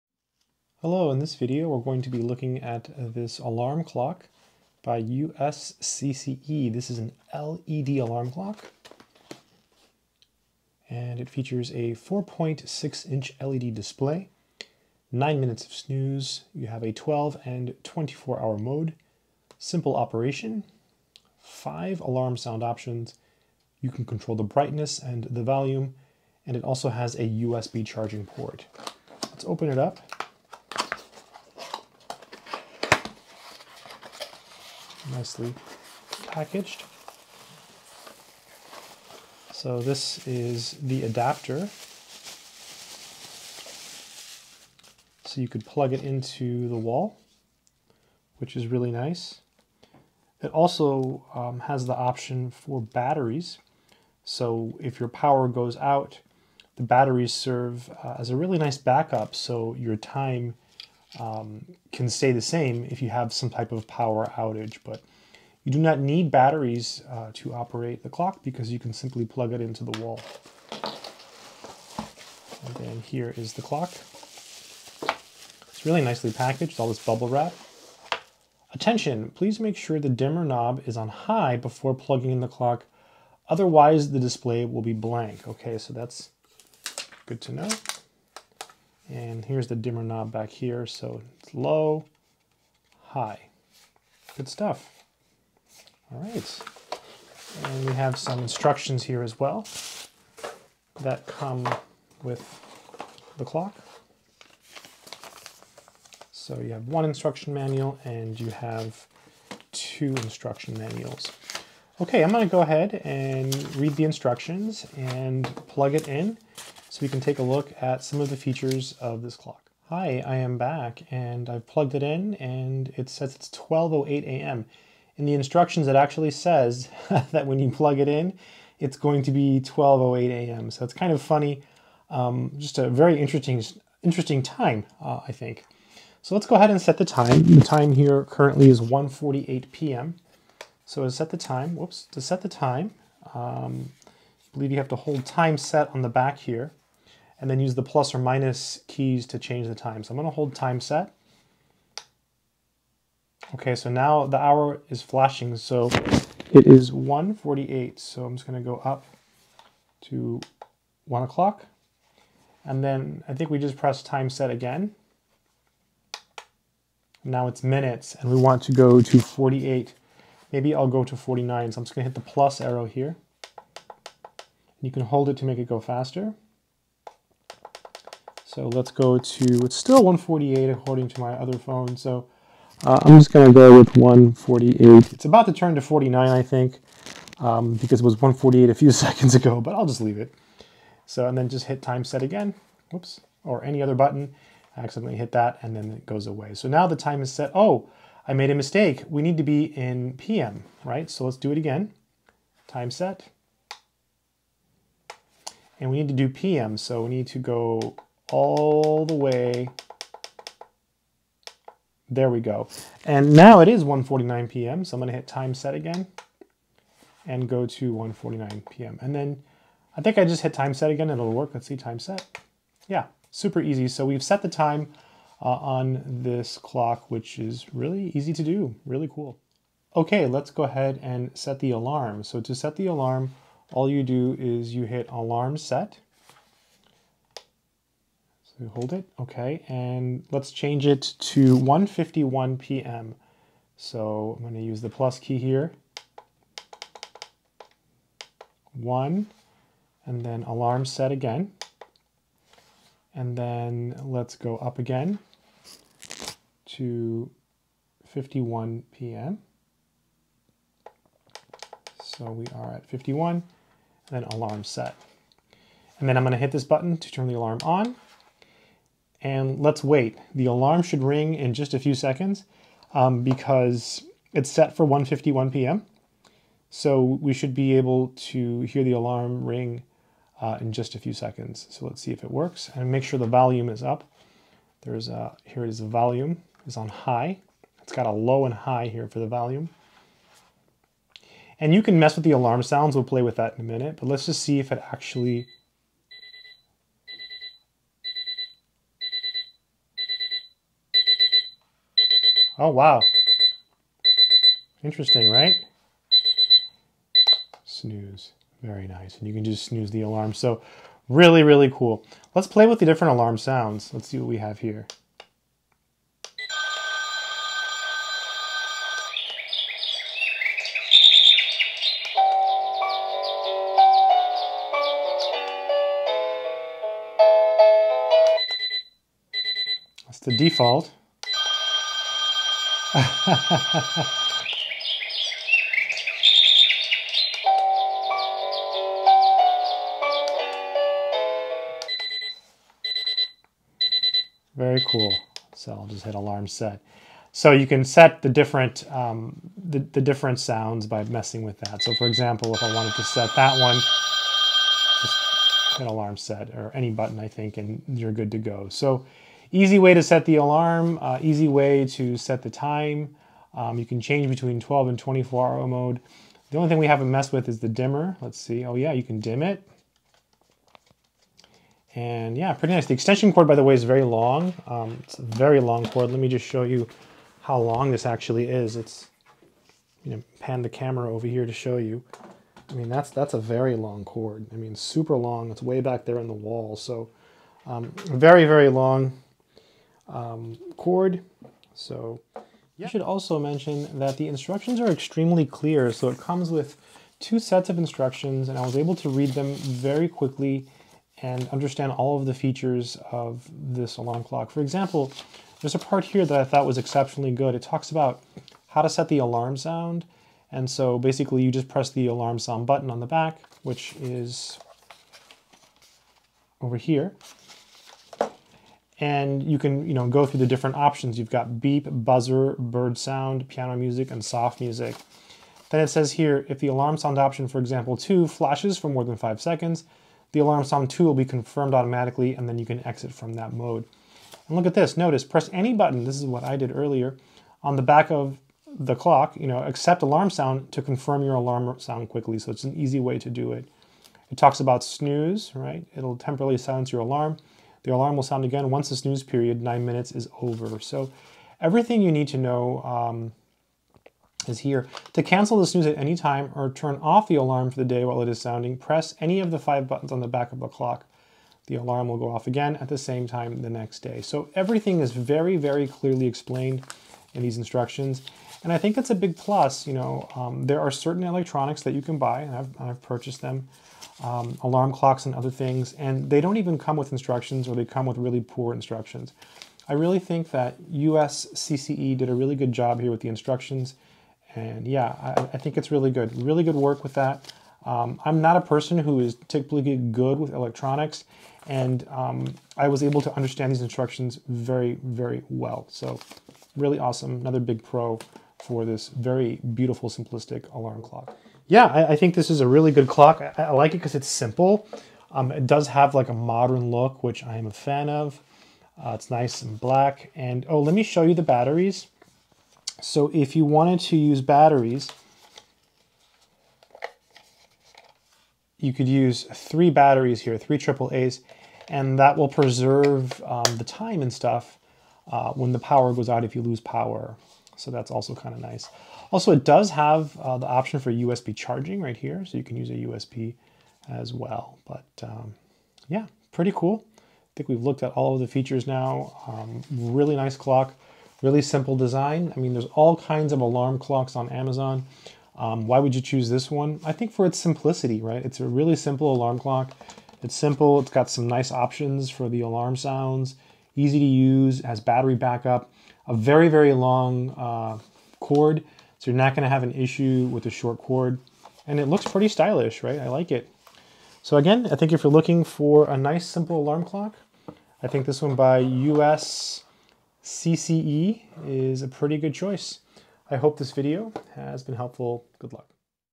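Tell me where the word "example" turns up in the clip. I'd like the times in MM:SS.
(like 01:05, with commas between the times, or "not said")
05:52, 06:44, 07:07.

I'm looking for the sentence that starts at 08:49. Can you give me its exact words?
Also, it does have uh, the option for USB charging right here.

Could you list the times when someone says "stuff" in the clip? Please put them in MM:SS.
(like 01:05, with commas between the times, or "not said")
01:34, 08:44.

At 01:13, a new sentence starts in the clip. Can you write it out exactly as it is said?
It's really nicely packaged, all this bubble wrap.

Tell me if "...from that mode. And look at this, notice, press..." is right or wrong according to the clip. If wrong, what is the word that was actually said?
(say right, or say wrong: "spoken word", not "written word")
right.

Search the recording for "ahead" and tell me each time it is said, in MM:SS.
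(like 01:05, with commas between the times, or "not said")
01:52, 02:16, 03:50.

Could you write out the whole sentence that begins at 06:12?
The extension cord, by the way, is very long.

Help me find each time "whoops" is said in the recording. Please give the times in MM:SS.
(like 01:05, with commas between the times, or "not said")
02:21, 03:12.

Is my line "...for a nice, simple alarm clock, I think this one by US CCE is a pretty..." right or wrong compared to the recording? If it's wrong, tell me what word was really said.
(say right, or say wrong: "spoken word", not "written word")
right.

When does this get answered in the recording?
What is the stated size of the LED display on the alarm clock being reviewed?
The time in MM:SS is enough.
00:11.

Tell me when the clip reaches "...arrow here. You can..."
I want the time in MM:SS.
02:52.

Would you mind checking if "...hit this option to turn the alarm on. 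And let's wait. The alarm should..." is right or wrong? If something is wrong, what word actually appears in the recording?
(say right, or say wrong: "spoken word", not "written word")
wrong: "button", not "option".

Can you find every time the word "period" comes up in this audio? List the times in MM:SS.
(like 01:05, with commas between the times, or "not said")
07:29.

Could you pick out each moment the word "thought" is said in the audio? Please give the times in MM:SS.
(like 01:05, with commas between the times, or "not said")
06:46.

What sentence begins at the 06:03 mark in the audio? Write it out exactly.
Um, you can change between 12 and 24 hour mode.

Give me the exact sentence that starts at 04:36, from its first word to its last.
So we should be able to hear the alarm ring uh, in just a few seconds.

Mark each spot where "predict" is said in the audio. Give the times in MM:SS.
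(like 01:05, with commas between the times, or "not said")
not said.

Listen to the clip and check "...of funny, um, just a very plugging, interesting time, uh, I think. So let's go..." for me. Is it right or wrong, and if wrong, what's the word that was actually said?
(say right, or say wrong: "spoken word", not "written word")
wrong: "interesting", not "plugging".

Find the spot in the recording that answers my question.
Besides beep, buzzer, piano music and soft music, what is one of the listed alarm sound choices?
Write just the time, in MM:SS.
07:02.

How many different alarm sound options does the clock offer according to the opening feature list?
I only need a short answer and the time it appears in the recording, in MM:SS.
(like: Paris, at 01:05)
5, at 00:21.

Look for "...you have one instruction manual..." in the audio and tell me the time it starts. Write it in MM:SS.
01:46.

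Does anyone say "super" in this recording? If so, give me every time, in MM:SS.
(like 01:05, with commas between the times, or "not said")
03:43, 06:24.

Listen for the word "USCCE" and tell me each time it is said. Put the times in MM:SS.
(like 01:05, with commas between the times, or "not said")
00:05, 08:00.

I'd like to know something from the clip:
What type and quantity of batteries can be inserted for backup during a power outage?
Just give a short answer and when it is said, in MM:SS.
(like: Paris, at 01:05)
3 AAA, at 08:40.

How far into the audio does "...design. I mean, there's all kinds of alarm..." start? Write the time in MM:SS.
09:01.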